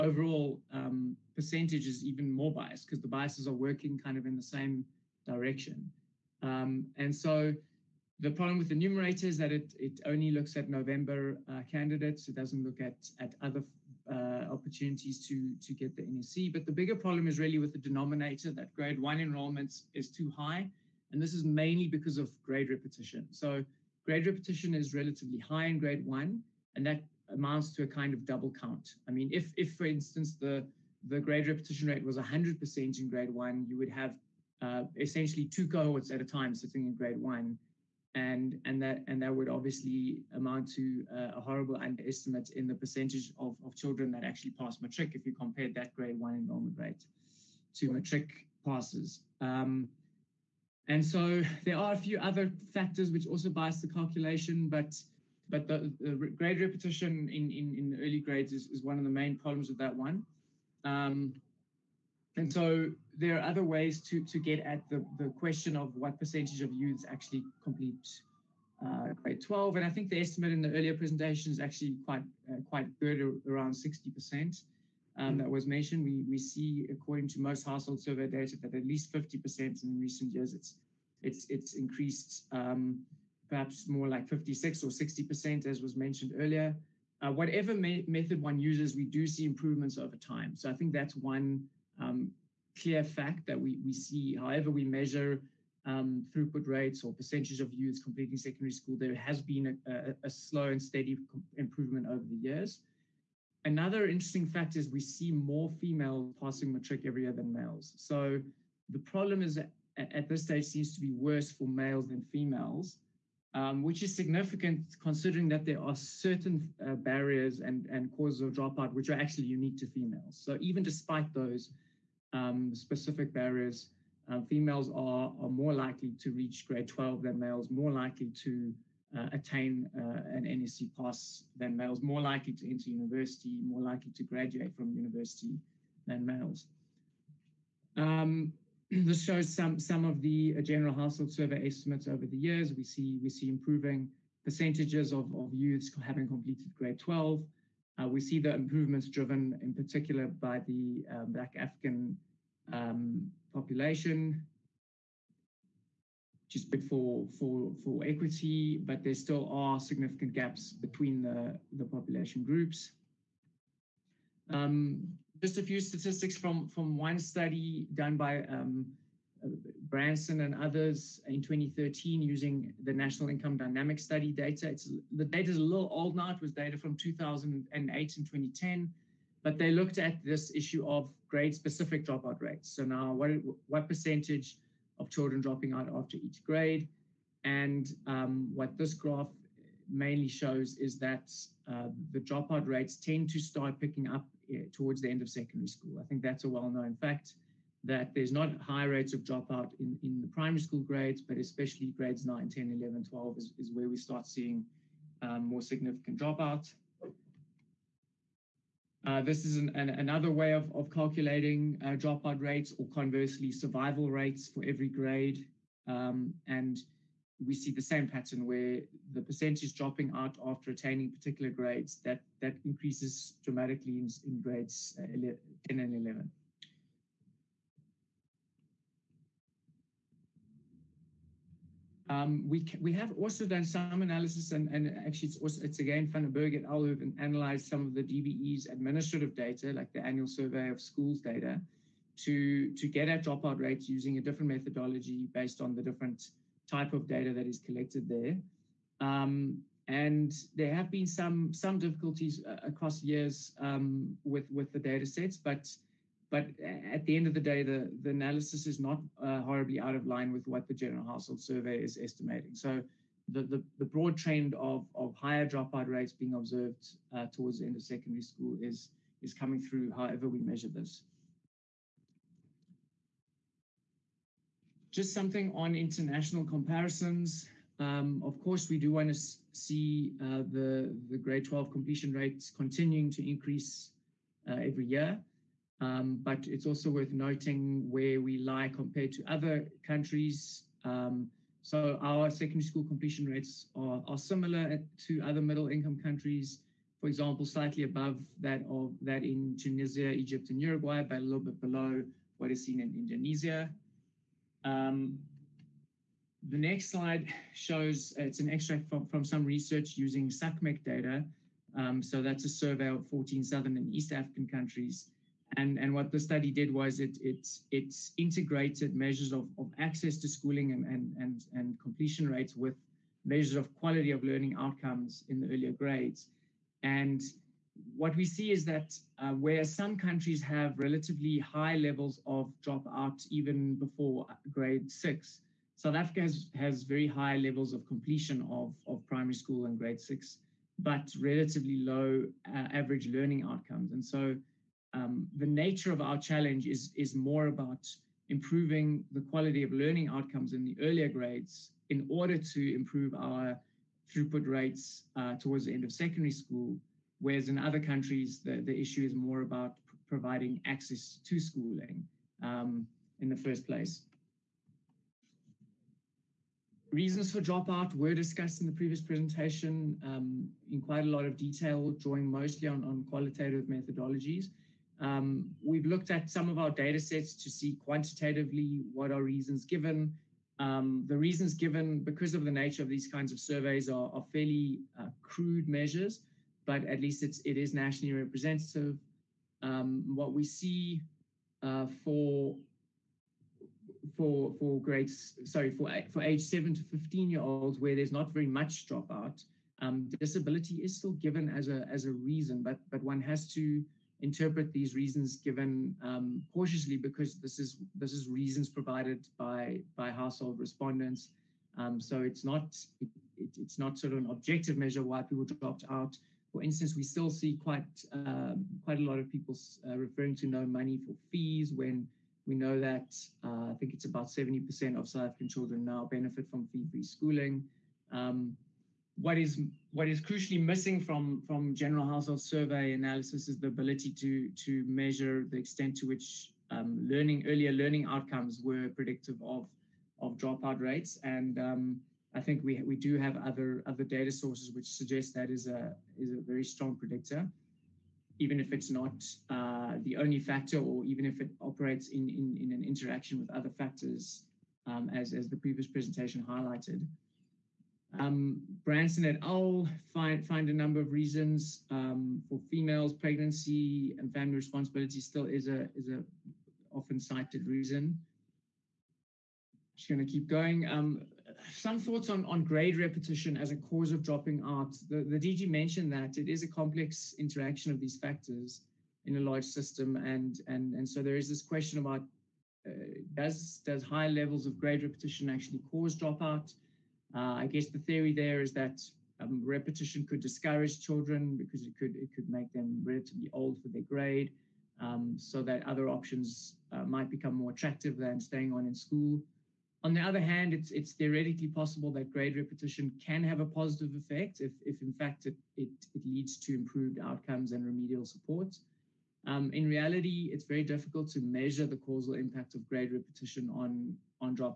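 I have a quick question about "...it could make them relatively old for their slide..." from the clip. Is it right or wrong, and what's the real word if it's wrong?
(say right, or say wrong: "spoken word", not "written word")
wrong: "grade", not "slide".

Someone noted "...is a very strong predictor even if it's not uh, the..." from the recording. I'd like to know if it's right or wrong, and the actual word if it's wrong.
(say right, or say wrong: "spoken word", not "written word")
right.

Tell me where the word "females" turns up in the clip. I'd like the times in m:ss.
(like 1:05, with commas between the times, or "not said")
1:45, 1:52, 1:59, 2:04, 7:42.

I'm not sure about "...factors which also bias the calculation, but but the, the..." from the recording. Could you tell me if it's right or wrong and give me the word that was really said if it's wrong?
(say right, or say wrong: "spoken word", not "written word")
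right.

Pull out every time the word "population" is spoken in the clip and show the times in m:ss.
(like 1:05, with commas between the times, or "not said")
2:33, 2:41.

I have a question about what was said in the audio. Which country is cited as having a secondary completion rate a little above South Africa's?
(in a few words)
Indonesia.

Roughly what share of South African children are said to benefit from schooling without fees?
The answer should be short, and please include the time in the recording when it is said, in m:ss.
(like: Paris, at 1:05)
70%, at 7:04.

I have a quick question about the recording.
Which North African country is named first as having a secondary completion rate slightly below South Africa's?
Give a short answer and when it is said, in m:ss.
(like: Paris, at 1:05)
Tunisia, at 4:59.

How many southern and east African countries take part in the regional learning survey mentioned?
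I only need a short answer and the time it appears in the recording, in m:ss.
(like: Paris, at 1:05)
14, at 5:13.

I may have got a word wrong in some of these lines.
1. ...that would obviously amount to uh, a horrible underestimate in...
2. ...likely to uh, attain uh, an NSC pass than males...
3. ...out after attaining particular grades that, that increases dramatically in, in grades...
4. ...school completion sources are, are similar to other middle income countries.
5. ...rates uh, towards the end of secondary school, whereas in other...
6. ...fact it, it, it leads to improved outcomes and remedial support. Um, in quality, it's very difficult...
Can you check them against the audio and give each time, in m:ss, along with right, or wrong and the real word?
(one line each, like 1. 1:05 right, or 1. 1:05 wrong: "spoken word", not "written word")
1. 0:39 right
2. 2:07 right
3. 3:40 right
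4. 4:52 wrong: "rates", not "sources"
5. 5:54 right
6. 8:25 wrong: "reality", not "quality".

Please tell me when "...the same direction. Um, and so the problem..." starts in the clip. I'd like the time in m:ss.
0:04.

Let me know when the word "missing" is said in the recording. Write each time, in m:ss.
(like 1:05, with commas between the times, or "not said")
7:10.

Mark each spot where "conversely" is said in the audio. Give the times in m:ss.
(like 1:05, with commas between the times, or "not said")
3:32.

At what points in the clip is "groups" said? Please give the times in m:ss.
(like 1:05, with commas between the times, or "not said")
2:42.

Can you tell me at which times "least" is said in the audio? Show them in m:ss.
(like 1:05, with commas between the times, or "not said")
1:18, 6:27.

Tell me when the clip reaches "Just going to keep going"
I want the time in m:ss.
7:49.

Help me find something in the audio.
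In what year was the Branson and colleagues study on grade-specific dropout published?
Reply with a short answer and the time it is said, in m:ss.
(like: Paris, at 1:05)
2013, at 2:51.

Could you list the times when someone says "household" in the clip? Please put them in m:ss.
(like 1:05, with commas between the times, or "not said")
1:17, 2:20, 4:21, 6:50, 7:12.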